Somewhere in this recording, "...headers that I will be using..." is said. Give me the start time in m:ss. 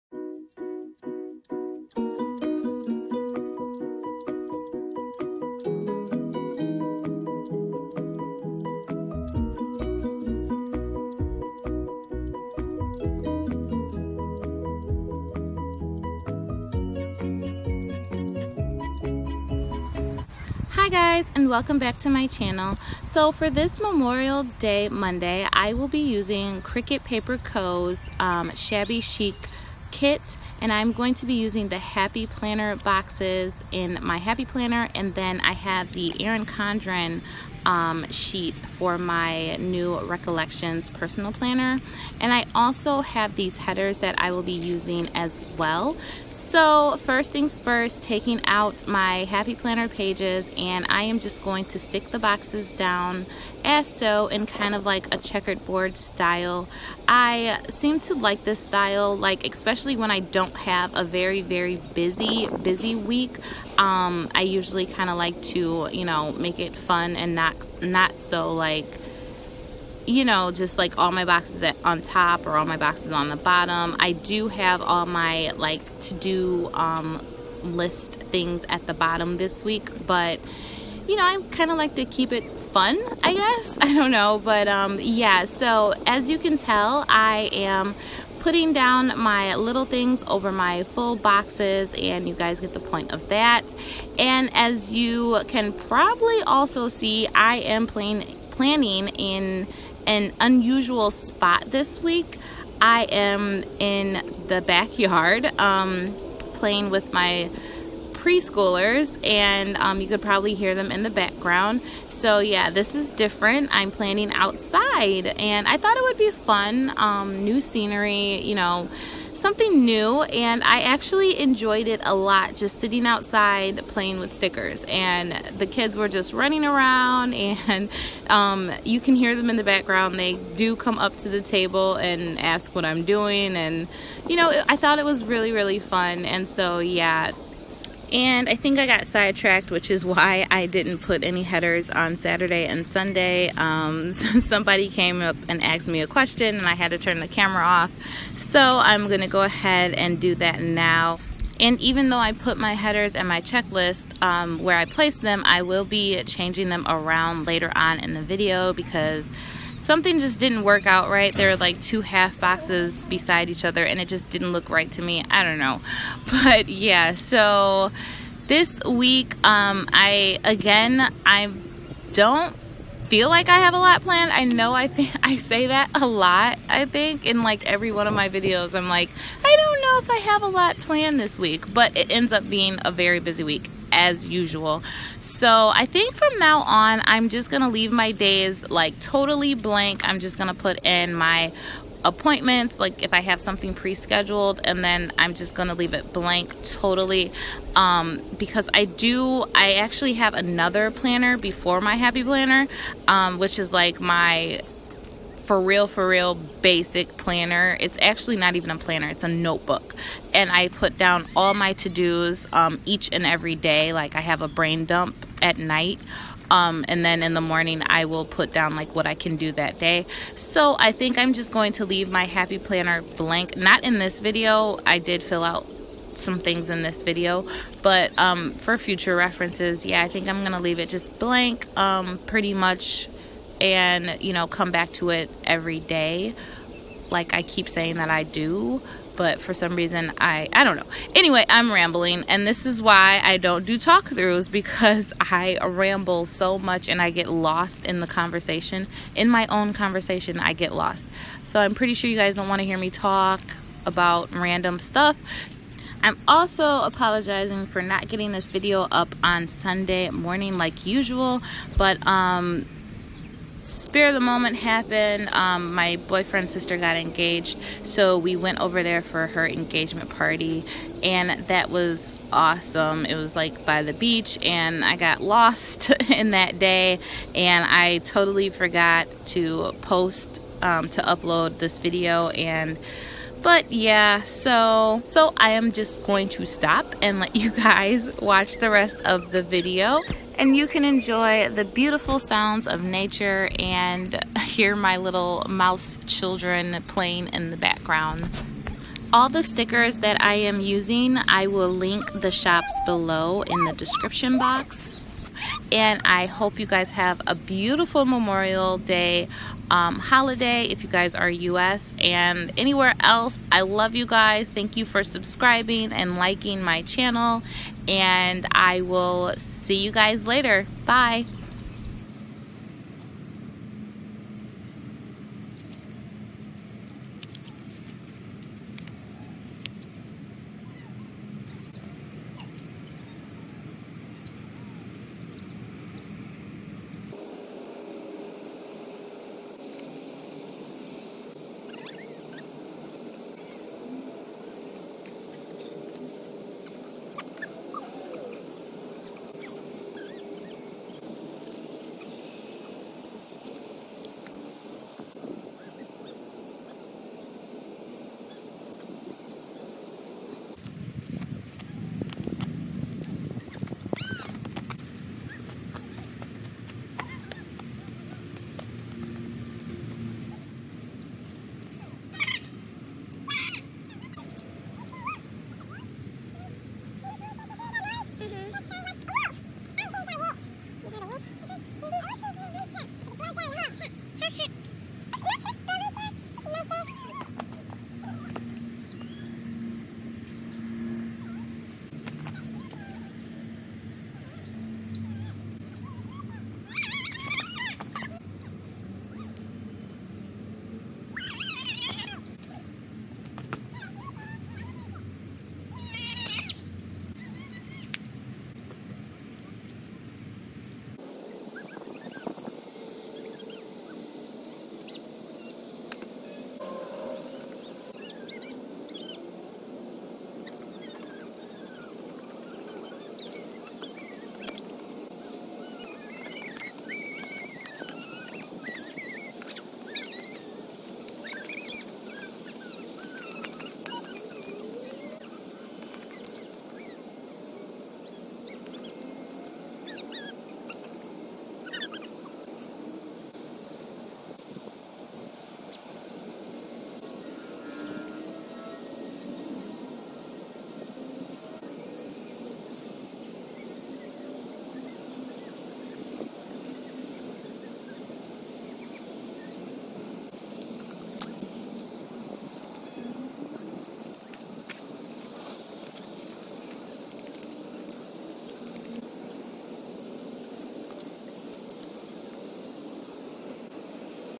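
0:43.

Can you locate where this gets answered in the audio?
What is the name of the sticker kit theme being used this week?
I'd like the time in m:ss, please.
0:28.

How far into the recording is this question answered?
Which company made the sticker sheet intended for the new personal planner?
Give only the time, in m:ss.
0:36.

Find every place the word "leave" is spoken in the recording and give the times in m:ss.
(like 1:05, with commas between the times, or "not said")
3:07, 3:15, 3:41, 3:50.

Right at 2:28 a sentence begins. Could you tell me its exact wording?
So I'm gonna go ahead and do that now.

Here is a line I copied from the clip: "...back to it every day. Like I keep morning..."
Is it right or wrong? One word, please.
wrong.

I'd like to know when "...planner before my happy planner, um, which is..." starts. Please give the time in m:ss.
3:20.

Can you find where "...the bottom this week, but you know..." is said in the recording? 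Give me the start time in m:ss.
1:18.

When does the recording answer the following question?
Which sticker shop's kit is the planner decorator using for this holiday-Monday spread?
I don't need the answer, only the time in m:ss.
0:26.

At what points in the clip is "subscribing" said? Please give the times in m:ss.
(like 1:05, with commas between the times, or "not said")
5:15.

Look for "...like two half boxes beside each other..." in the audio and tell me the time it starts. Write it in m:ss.
2:41.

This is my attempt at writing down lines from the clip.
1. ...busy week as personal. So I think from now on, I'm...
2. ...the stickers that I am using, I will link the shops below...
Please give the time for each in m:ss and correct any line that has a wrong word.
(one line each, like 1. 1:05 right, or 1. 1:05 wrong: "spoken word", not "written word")
1. 3:03 wrong: "usual", not "personal"
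2. 4:59 right.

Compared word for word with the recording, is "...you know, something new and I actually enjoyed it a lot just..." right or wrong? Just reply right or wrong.
right.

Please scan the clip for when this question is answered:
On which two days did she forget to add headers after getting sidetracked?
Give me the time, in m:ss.
2:22.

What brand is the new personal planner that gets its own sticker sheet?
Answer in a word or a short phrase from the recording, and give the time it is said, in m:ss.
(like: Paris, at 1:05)
Recollections, at 0:39.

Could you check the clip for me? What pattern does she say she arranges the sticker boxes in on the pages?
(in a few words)
checkered board style.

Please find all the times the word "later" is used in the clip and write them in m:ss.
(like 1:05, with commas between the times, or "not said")
2:37, 5:20.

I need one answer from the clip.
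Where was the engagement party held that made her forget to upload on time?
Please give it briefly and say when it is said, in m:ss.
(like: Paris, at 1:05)
by the beach, at 4:33.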